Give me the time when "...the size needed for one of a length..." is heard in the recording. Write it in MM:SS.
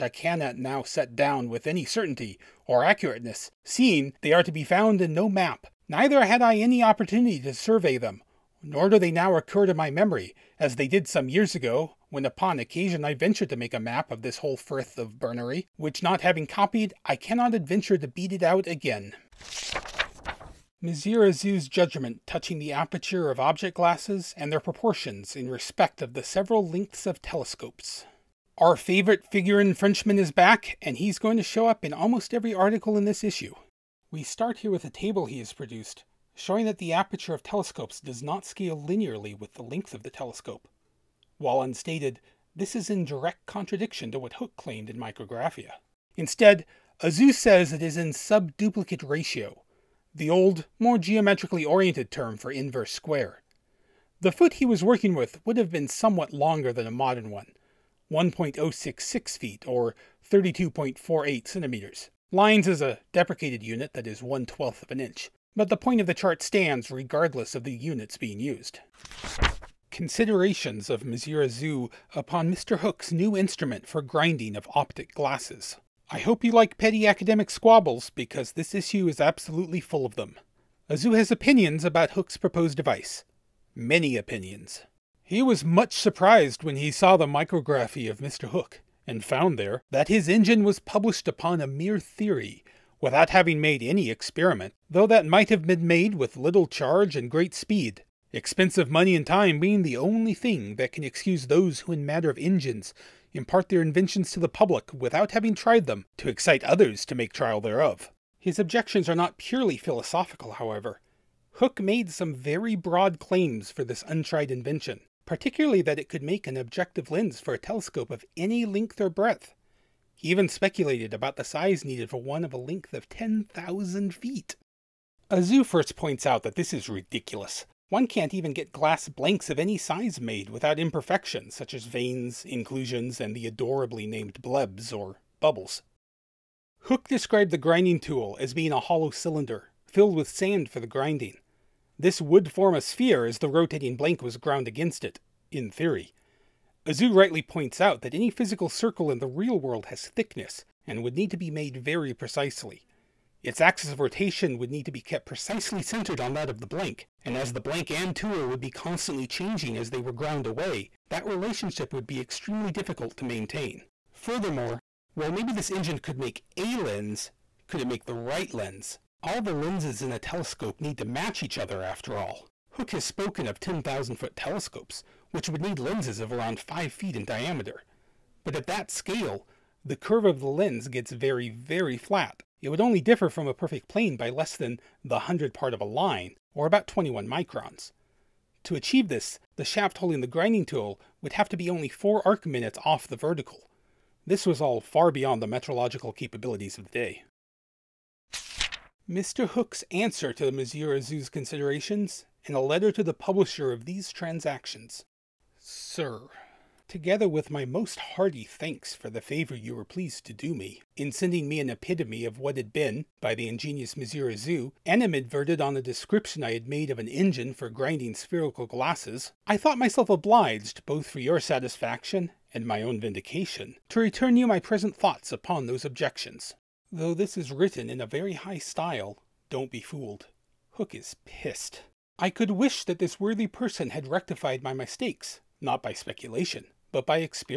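02:01.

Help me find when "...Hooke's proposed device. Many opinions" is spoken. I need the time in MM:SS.
01:22.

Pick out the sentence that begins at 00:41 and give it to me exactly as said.
While unstated, this is in direct contradiction to what Hooke claimed in Micrographia.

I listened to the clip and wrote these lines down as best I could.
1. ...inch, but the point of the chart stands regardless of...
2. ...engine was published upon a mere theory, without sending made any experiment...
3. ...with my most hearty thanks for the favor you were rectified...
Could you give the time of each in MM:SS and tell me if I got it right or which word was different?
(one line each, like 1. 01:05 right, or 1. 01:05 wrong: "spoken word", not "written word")
1. 01:05 right
2. 01:30 wrong: "having", not "sending"
3. 03:27 wrong: "pleased", not "rectified".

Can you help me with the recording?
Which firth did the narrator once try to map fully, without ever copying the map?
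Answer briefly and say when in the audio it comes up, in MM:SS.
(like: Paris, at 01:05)
Berneray, at 00:15.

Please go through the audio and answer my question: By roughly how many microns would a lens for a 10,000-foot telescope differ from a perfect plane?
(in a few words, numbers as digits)
21.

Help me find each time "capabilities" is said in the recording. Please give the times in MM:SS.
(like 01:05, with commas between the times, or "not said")
03:16.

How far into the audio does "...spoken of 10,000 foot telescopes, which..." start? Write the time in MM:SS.
02:53.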